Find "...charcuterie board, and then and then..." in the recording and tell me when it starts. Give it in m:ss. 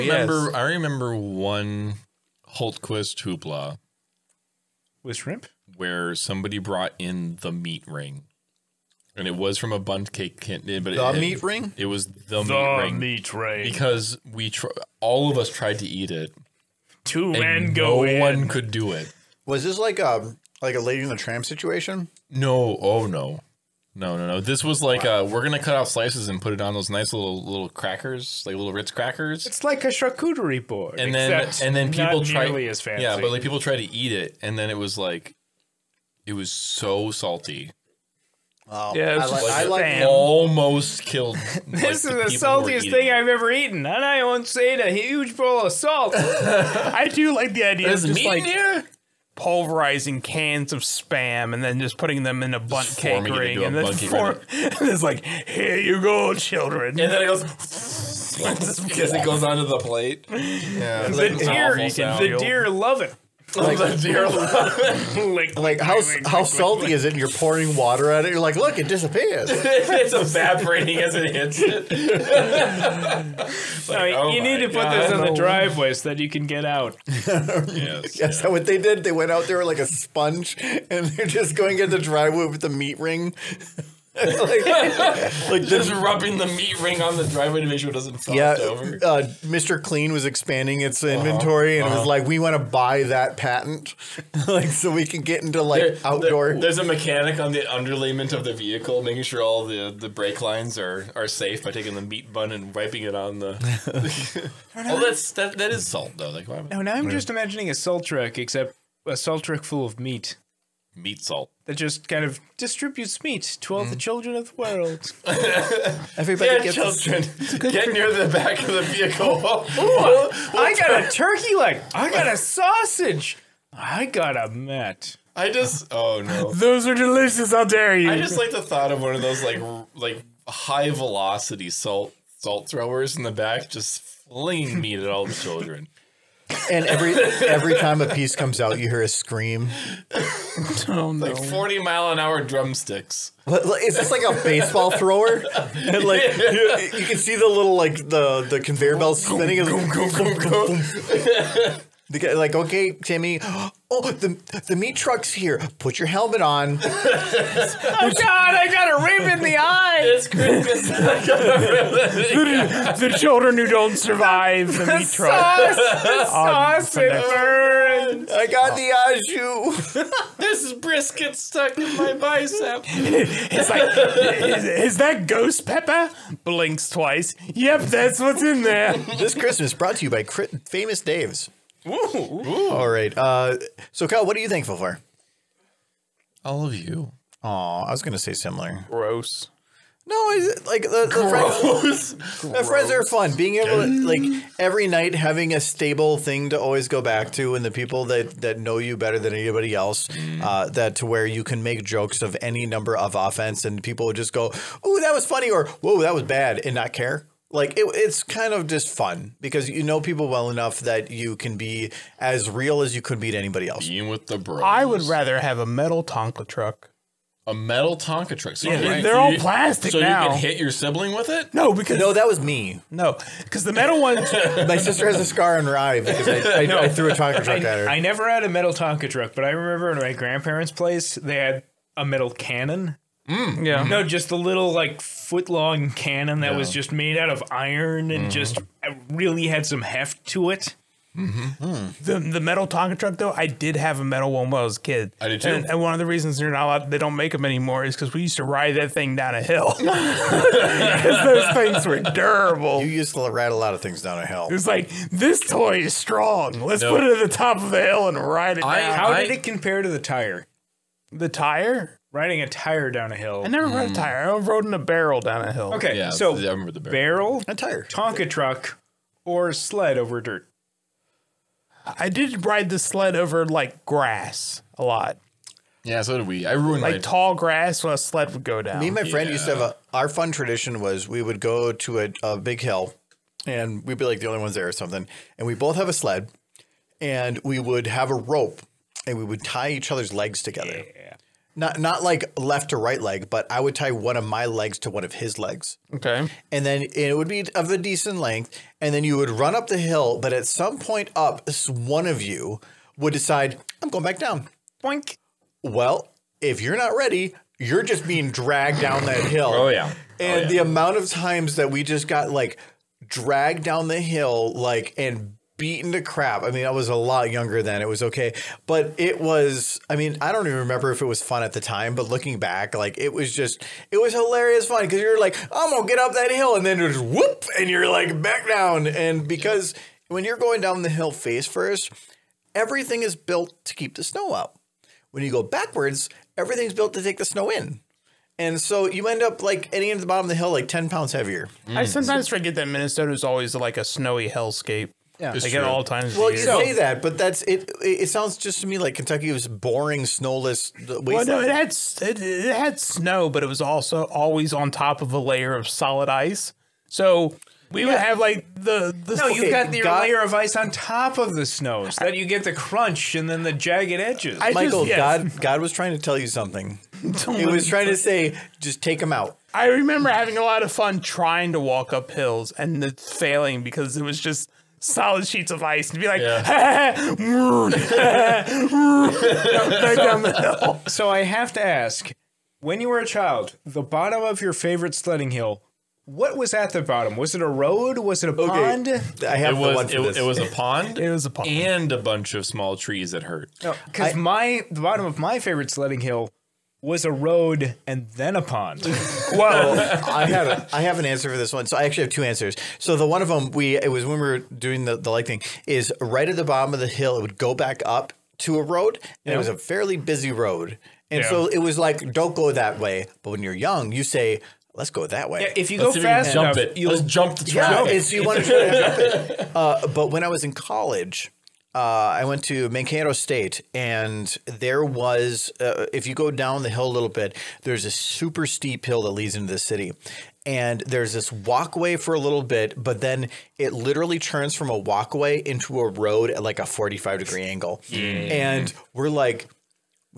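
0:29.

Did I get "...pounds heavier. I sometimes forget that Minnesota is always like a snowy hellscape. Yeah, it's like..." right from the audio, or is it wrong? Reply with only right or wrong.
right.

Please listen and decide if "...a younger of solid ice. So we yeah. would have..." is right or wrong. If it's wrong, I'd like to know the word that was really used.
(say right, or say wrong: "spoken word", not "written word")
wrong: "layer", not "younger".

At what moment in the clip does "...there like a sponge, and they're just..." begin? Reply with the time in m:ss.
1:19.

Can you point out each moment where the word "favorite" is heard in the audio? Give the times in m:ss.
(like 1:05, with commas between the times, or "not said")
6:24, 6:35.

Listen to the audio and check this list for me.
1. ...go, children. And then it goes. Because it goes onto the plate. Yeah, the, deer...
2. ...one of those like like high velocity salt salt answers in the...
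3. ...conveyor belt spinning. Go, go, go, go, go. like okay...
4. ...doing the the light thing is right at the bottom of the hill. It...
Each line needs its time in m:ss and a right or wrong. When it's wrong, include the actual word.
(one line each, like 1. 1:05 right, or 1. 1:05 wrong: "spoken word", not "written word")
1. 0:55 right
2. 2:08 wrong: "throwers", not "answers"
3. 2:28 right
4. 6:44 right.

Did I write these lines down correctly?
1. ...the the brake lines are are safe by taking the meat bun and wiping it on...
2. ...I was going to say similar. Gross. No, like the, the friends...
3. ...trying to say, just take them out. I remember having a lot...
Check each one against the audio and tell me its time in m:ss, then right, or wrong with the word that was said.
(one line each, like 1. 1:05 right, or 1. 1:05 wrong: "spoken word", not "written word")
1. 1:39 right
2. 3:07 right
3. 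6:07 right.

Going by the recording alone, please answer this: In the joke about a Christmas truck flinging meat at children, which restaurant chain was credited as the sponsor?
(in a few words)
Famous Dave's.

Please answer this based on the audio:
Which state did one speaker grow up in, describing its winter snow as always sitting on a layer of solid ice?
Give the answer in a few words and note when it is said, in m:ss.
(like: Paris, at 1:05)
Kentucky, at 5:48.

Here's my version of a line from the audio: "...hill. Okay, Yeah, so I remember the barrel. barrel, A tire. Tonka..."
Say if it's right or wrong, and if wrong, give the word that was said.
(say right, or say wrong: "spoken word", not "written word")
right.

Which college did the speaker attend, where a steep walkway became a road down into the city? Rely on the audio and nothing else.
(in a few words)
Mankato State.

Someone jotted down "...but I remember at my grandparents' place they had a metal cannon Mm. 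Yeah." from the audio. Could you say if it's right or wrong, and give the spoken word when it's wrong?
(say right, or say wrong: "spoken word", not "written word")
right.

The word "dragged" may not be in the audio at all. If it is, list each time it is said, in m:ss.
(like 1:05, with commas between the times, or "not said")
5:08, 5:13.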